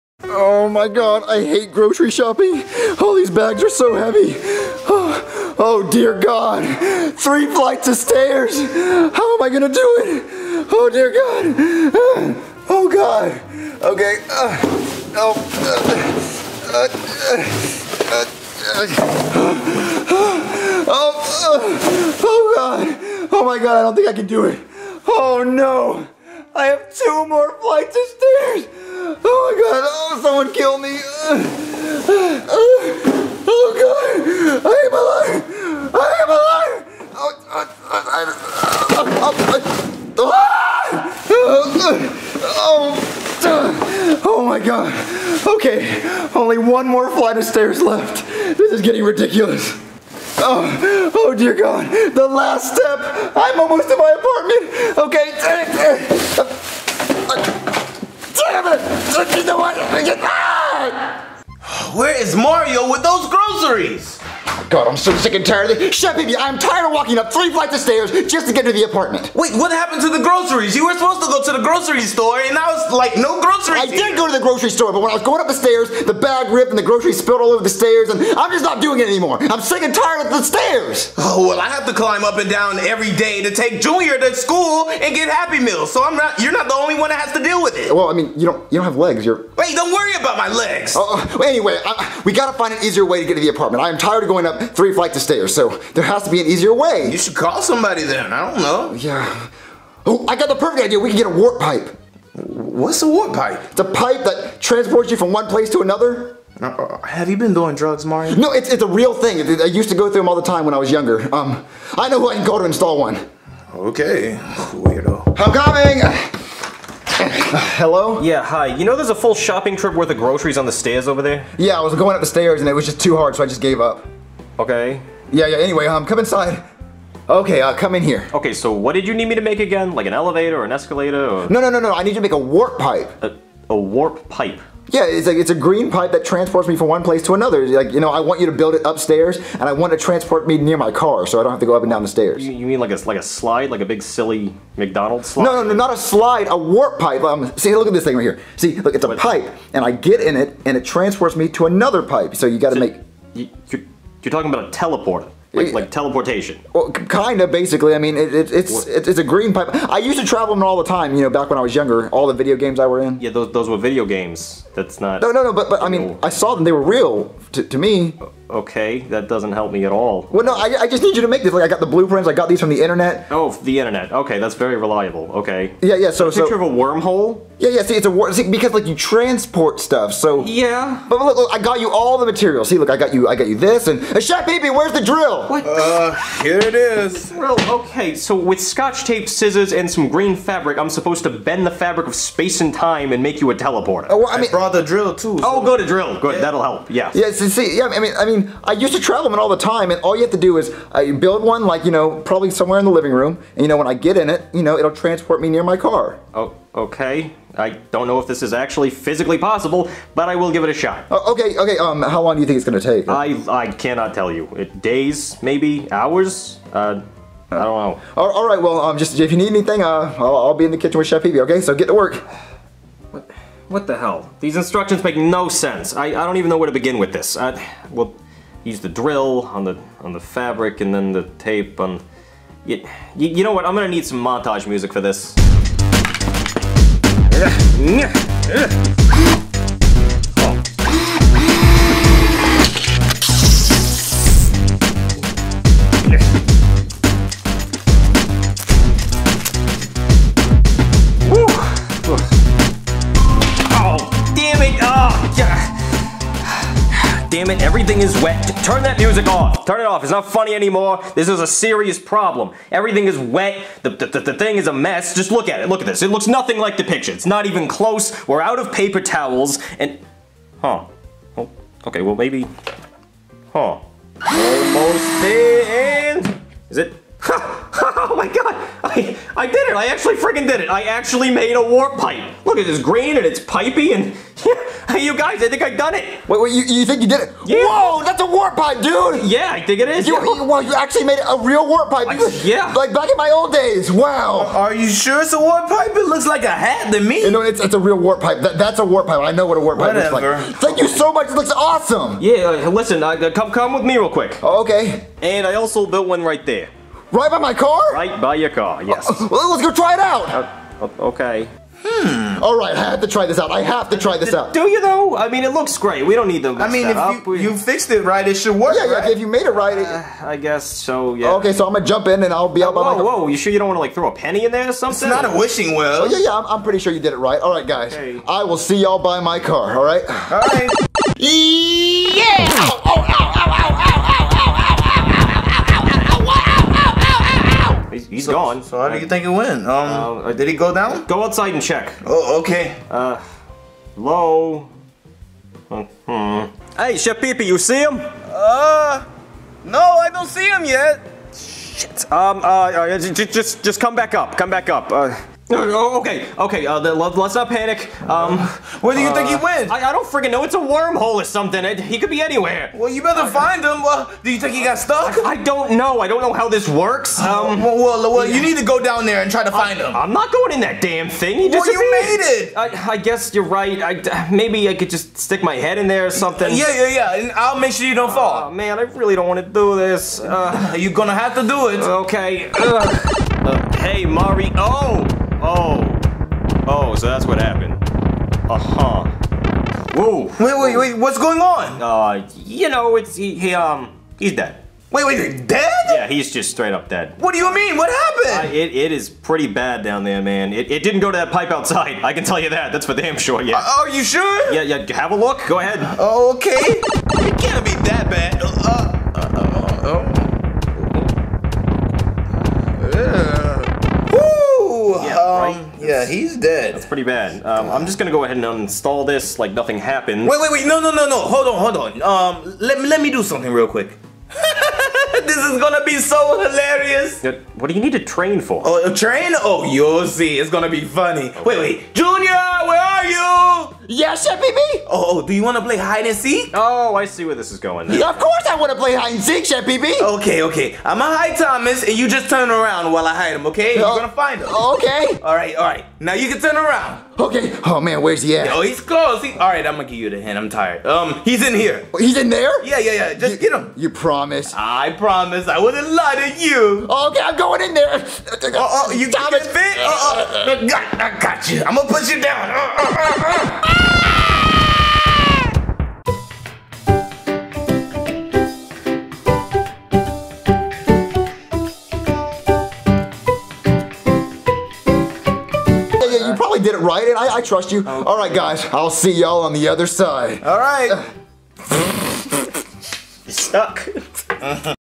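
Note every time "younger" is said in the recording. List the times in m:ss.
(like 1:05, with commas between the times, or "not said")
1:50, 2:41.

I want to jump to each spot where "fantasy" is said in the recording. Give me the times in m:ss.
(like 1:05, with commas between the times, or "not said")
not said.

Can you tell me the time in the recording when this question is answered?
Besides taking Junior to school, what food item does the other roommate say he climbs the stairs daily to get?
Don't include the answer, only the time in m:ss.
1:25.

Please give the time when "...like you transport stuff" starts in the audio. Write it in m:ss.
2:58.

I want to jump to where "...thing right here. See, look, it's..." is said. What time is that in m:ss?
2:28.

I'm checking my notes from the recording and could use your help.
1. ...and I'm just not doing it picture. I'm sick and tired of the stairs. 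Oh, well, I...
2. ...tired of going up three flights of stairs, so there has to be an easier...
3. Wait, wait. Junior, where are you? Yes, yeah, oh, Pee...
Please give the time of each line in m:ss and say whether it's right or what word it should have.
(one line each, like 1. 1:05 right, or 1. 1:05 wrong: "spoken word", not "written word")
1. 1:18 wrong: "anymore", not "picture"
2. 1:33 right
3. 7:11 wrong: "Chef", not "Pee".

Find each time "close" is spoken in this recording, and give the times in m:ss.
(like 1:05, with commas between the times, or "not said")
4:27, 7:28.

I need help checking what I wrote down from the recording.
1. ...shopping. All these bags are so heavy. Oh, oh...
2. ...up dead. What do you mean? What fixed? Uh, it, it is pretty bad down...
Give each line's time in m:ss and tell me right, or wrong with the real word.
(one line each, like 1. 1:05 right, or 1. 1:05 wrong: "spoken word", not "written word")
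1. 0:02 right
2. 6:36 wrong: "happened", not "fixed".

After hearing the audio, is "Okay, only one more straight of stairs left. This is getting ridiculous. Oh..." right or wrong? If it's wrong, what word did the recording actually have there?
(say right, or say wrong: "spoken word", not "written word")
wrong: "flight", not "straight".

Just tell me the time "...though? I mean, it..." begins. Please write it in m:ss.
5:14.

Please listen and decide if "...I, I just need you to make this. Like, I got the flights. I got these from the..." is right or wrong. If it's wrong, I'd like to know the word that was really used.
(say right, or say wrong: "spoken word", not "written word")
wrong: "blueprints", not "flights".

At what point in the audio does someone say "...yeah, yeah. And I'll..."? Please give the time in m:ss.
6:16.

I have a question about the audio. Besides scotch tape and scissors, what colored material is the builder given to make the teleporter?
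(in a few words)
green fabric.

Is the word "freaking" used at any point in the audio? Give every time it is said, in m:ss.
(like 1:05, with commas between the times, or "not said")
4:40, 6:00.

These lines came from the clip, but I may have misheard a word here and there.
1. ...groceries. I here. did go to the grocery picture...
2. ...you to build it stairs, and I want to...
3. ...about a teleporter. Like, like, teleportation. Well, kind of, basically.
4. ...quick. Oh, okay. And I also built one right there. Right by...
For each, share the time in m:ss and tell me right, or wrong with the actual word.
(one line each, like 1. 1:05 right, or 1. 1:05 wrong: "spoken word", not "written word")
1. 1:13 wrong: "store", not "picture"
2. 2:18 wrong: "upstairs", not "stairs"
3. 2:34 right
4. 5:04 right.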